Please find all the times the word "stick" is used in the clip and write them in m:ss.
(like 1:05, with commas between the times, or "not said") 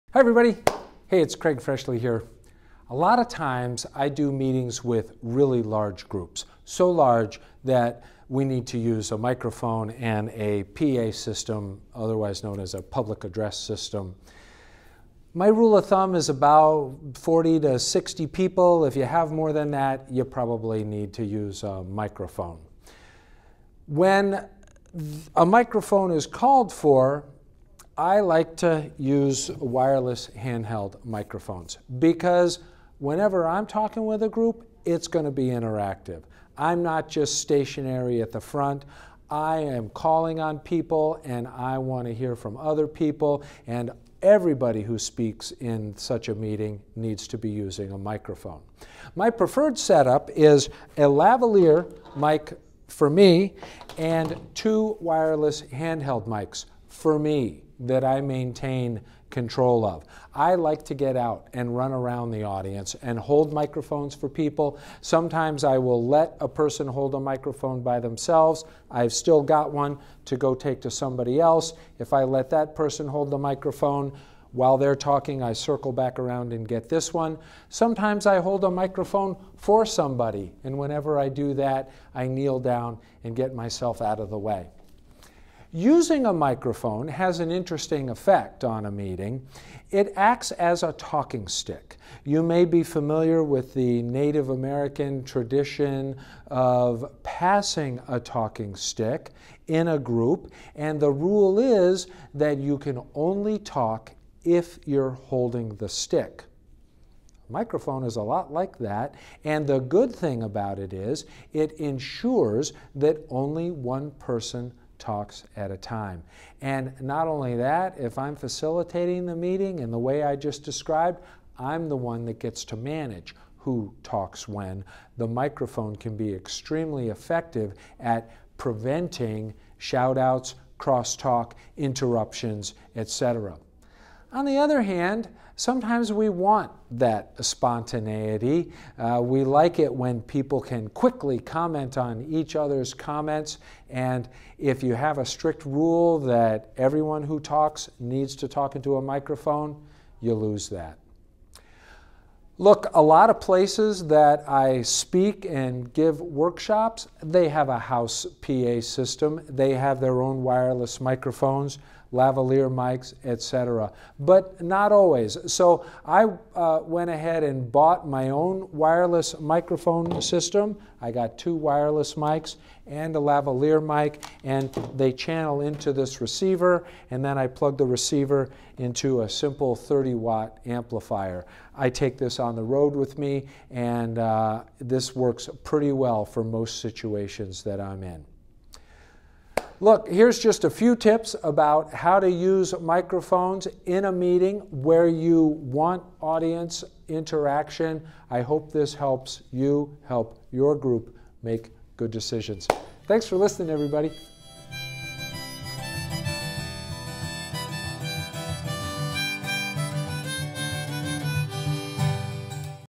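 1:31, 1:38, 1:45.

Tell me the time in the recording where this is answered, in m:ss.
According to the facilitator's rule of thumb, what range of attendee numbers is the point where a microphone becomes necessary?
0:17.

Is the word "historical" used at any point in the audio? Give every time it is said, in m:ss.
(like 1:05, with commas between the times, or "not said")
not said.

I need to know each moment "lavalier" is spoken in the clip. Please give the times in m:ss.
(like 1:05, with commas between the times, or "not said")
0:51, 2:42, 2:53.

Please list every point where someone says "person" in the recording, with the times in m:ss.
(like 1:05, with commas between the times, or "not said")
1:06, 1:12, 1:54.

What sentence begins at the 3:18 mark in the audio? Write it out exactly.
I hope this helps you help your group make good decisions.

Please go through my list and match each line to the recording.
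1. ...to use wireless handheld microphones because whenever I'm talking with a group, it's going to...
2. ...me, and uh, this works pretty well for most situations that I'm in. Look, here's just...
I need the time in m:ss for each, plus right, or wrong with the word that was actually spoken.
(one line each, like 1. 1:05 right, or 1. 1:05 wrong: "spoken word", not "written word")
1. 0:28 right
2. 3:03 right.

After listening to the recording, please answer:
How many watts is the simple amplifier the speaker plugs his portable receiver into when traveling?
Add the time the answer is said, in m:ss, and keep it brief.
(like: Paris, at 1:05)
30, at 2:59.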